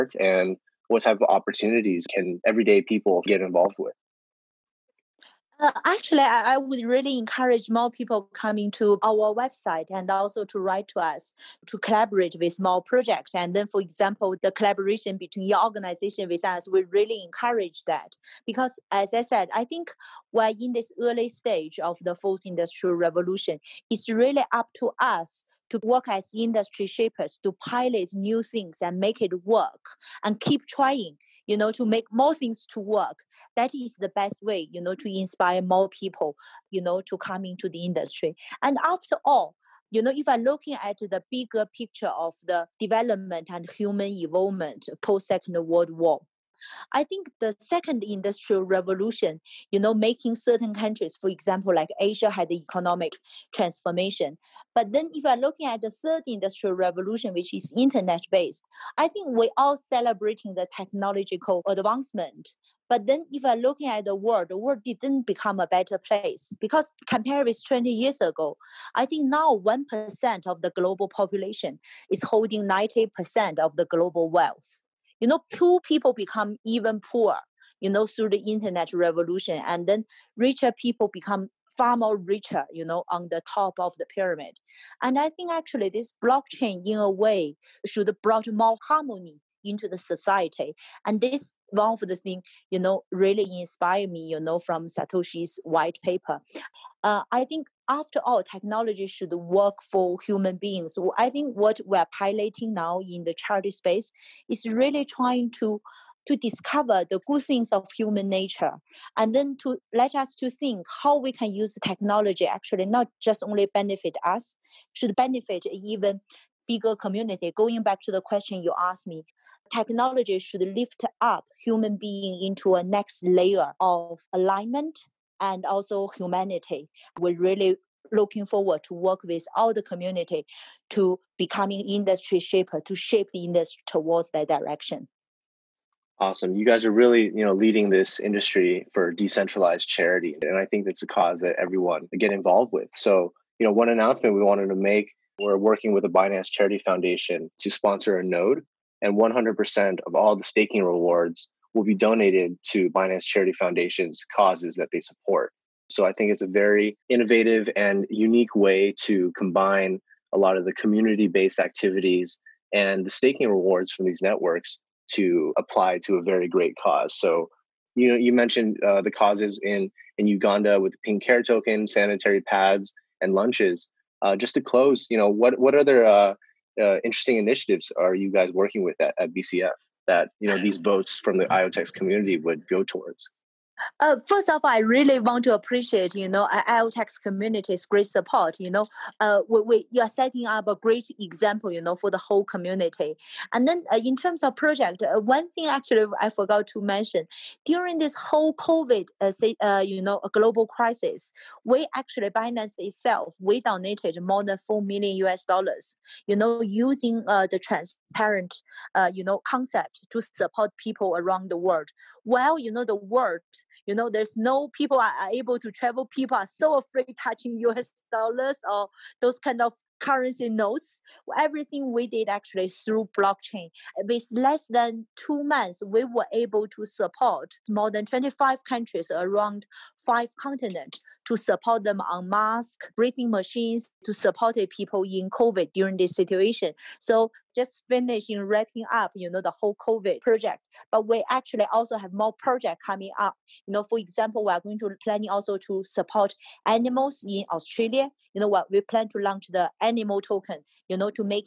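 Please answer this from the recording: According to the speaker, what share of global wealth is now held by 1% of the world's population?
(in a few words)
90%.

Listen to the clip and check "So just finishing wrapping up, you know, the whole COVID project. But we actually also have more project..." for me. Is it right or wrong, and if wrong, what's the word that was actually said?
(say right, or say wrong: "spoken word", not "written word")
right.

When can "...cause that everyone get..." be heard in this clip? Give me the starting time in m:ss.
2:21.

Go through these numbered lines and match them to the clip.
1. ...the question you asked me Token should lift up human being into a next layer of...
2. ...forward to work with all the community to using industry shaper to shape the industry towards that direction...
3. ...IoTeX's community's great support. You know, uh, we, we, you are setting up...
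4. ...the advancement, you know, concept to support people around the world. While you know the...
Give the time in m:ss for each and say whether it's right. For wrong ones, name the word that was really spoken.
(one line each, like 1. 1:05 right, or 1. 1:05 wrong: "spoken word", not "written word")
1. 1:58 wrong: "Technology", not "Token"
2. 2:08 wrong: "becoming", not "using"
3. 3:06 right
4. 3:27 wrong: "transparent", not "advancement".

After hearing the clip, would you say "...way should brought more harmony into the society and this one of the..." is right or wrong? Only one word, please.
right.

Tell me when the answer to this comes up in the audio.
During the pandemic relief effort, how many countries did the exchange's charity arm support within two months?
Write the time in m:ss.
3:48.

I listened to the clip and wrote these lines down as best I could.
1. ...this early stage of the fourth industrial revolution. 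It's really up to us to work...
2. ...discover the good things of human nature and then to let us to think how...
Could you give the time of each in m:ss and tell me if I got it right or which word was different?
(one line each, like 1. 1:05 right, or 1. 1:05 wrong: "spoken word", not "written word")
1. 0:20 right
2. 1:46 right.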